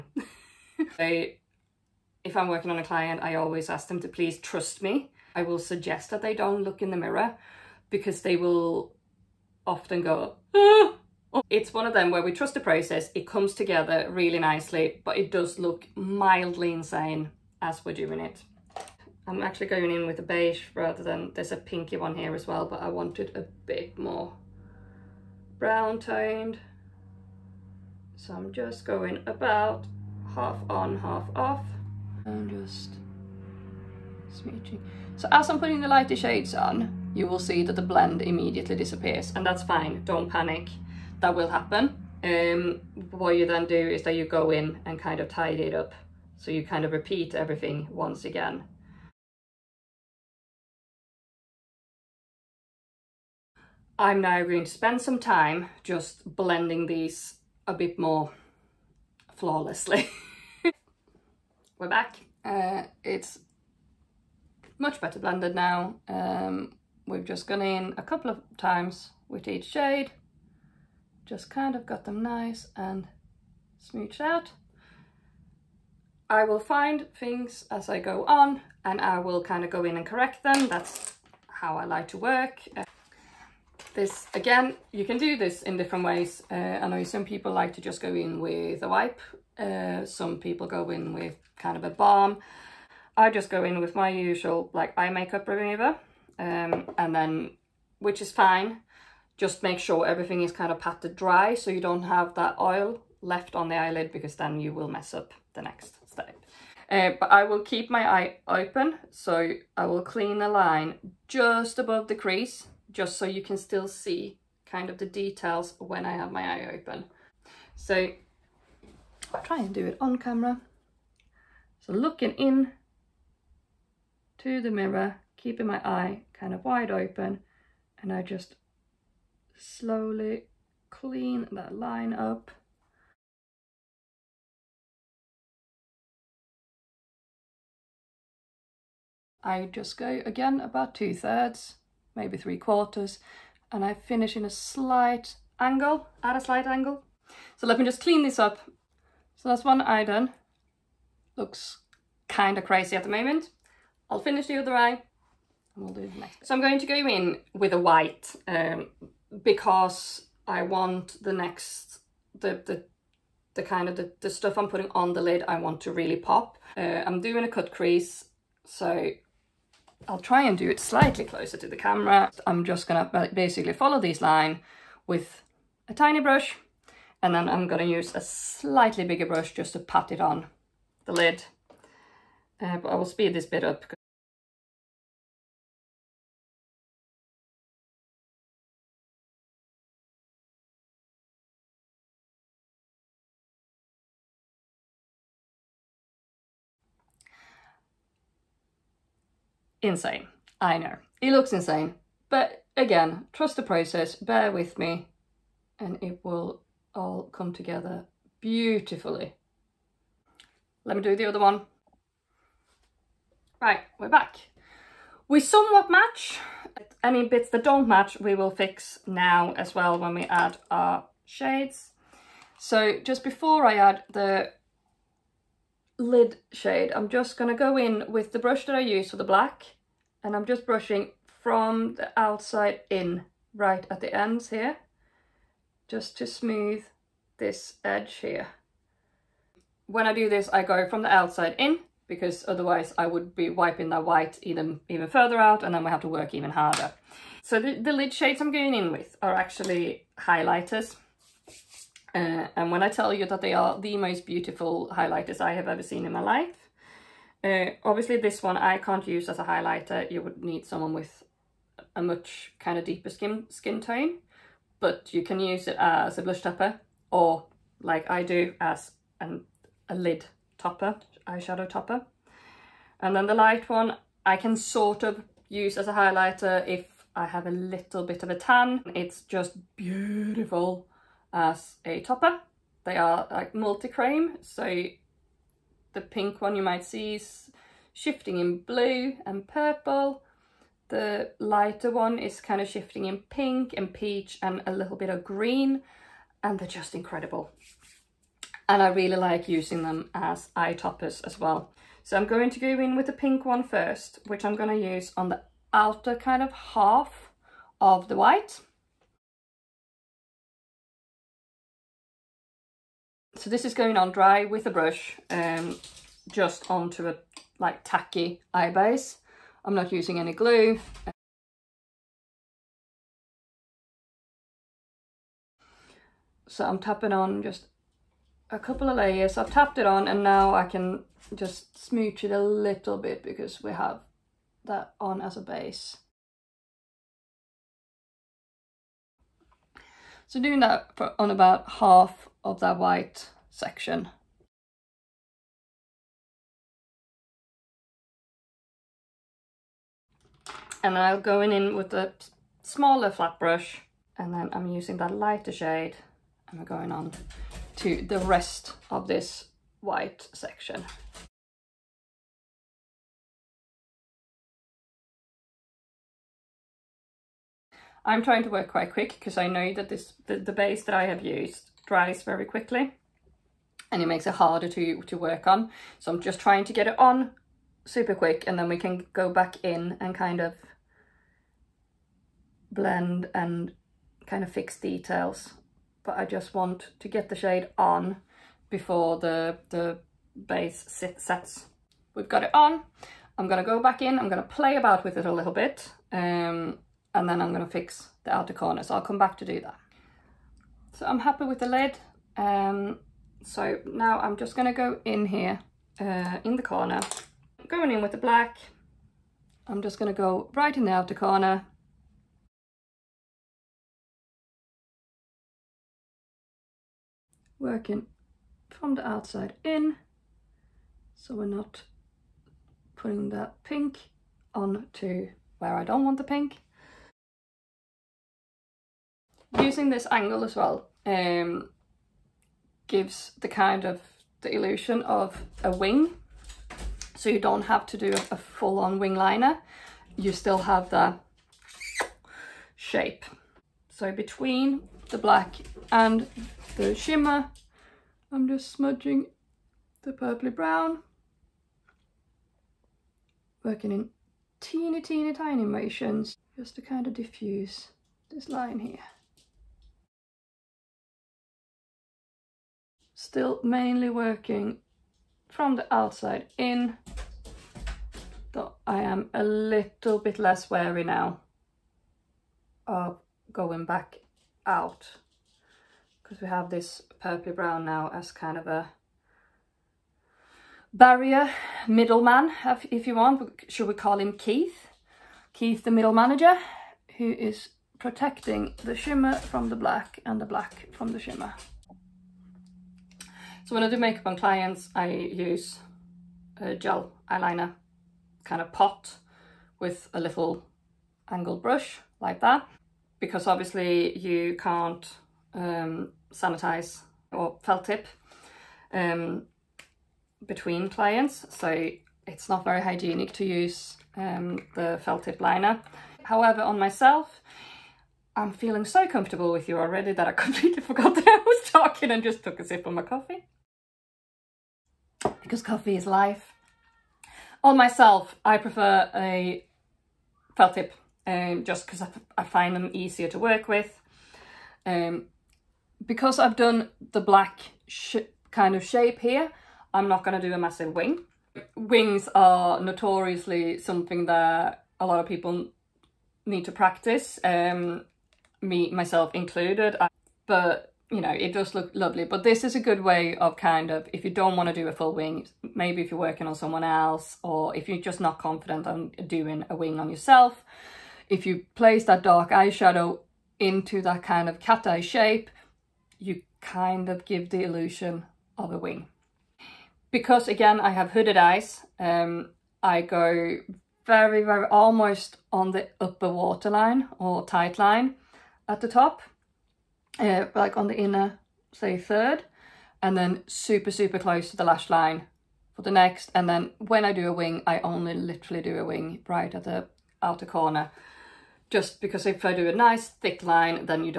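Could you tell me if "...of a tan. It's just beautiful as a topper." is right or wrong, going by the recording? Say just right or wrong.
right.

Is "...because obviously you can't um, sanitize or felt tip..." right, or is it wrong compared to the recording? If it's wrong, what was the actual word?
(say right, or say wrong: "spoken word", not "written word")
right.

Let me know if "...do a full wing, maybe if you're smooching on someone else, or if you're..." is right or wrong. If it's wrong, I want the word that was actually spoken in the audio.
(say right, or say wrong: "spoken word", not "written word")
wrong: "working", not "smooching".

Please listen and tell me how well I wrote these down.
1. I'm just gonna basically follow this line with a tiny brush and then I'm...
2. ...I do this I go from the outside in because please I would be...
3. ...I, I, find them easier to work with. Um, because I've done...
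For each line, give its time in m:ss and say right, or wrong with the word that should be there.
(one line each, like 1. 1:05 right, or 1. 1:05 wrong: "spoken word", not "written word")
1. 2:52 right
2. 4:00 wrong: "otherwise", not "please"
3. 8:52 right.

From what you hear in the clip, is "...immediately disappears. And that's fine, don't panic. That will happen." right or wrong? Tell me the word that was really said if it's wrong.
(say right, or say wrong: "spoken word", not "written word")
right.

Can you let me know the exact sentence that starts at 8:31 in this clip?
So it's not very hygienic to use um, the felt tip liner.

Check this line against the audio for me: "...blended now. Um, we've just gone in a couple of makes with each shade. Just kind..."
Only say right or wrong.
wrong.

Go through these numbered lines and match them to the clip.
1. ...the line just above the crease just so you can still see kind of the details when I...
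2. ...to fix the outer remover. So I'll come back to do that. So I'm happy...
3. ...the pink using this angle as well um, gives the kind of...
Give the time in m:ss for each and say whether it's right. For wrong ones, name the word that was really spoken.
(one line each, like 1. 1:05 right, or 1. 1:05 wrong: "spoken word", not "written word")
1. 1:50 right
2. 6:37 wrong: "corner", not "remover"
3. 7:06 right.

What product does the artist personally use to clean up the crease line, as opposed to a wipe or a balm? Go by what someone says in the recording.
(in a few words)
eye makeup remover.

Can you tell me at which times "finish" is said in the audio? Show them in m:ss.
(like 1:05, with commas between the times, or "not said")
2:23, 2:34.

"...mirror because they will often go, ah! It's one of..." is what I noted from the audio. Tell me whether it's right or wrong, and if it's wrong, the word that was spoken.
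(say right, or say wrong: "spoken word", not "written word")
right.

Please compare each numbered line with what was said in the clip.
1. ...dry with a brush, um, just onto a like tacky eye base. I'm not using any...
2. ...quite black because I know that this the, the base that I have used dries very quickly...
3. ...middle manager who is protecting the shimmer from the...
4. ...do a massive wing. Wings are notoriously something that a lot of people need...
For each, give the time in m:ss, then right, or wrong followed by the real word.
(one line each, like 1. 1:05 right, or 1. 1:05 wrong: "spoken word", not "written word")
1. 5:14 right
2. 6:08 wrong: "quick", not "black"
3. 8:05 right
4. 9:00 right.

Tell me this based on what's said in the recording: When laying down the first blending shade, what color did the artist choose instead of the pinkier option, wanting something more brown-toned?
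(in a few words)
beige.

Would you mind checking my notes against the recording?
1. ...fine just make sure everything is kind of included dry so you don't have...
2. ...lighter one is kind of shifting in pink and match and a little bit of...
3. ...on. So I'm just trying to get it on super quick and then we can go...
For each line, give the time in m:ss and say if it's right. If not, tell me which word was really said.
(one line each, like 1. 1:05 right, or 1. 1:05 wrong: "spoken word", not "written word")
1. 1:38 wrong: "patted", not "included"
2. 4:51 wrong: "peach", not "match"
3. 6:15 right.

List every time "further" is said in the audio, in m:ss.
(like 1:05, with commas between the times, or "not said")
4:05.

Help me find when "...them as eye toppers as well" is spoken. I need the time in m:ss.
4:59.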